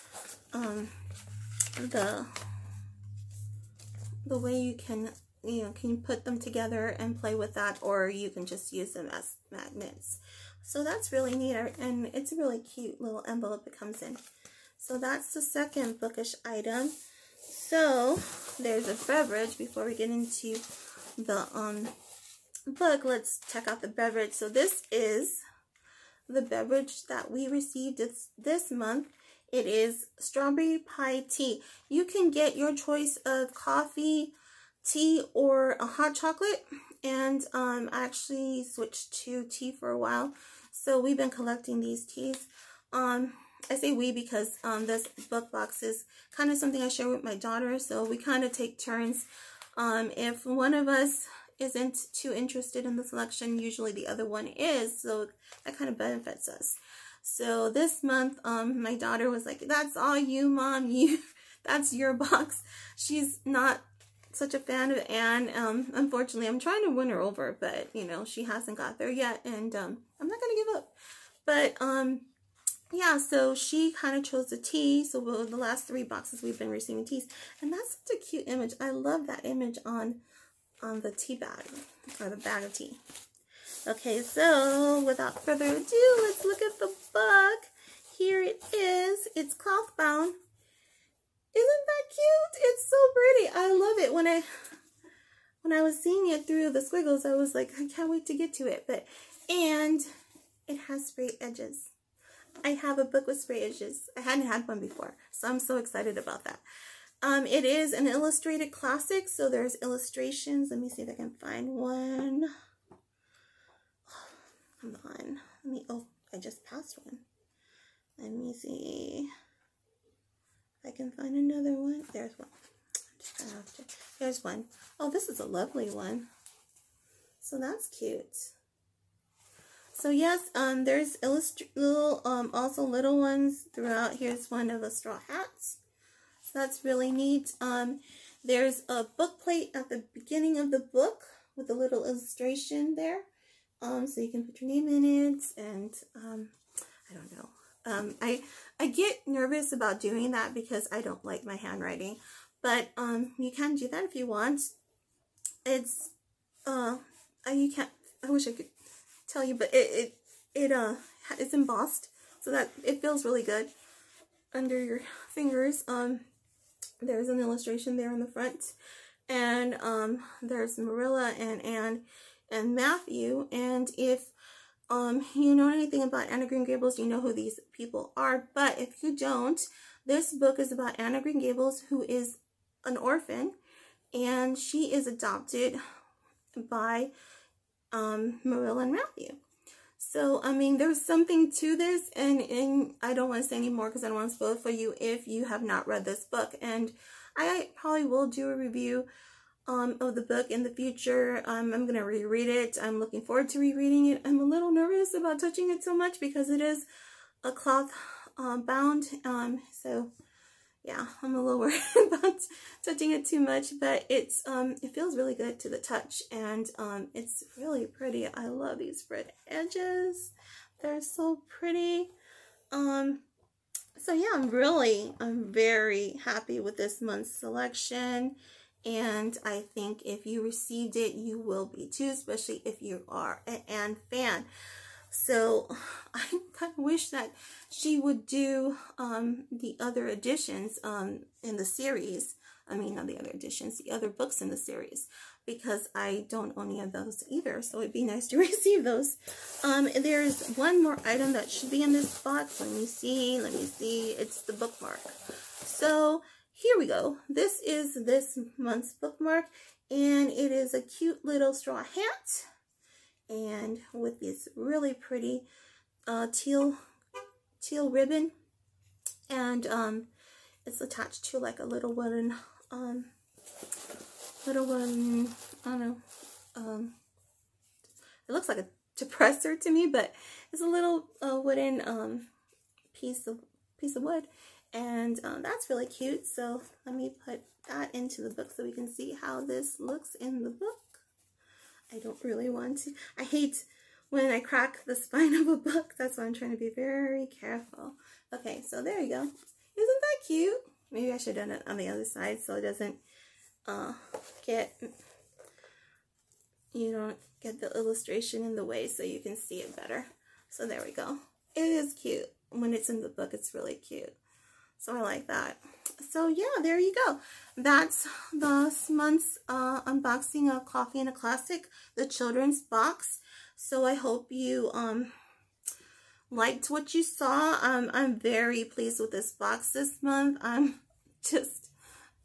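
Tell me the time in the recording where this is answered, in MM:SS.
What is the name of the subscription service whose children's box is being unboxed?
05:20.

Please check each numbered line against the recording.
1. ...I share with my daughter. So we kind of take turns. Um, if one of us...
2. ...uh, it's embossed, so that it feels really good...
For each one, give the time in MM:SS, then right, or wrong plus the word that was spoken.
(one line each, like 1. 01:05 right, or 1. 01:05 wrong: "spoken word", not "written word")
1. 00:46 right
2. 02:40 right.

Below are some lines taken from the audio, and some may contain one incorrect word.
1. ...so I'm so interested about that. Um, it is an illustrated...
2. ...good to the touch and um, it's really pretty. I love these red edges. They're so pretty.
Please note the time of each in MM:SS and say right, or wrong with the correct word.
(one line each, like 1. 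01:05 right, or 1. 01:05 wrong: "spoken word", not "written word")
1. 01:45 wrong: "excited", not "interested"
2. 03:35 right.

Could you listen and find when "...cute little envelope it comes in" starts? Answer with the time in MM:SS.
00:12.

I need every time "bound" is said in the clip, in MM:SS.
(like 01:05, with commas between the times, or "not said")
01:29, 03:28.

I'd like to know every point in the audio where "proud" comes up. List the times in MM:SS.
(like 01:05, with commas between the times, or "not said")
not said.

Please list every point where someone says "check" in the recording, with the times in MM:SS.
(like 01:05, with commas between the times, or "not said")
00:23.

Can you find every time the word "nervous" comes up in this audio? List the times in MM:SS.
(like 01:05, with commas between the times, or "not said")
02:29, 03:24.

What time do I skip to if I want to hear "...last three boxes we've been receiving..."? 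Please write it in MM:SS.
01:15.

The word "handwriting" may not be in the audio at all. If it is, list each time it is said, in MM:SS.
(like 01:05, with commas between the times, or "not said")
02:31.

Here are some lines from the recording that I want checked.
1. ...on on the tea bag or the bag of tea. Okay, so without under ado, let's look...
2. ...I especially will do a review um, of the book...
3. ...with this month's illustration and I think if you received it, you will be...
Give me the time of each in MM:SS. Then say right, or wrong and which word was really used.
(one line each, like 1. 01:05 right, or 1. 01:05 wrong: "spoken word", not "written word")
1. 01:19 wrong: "further", not "under"
2. 03:17 wrong: "probably", not "especially"
3. 03:46 wrong: "selection", not "illustration".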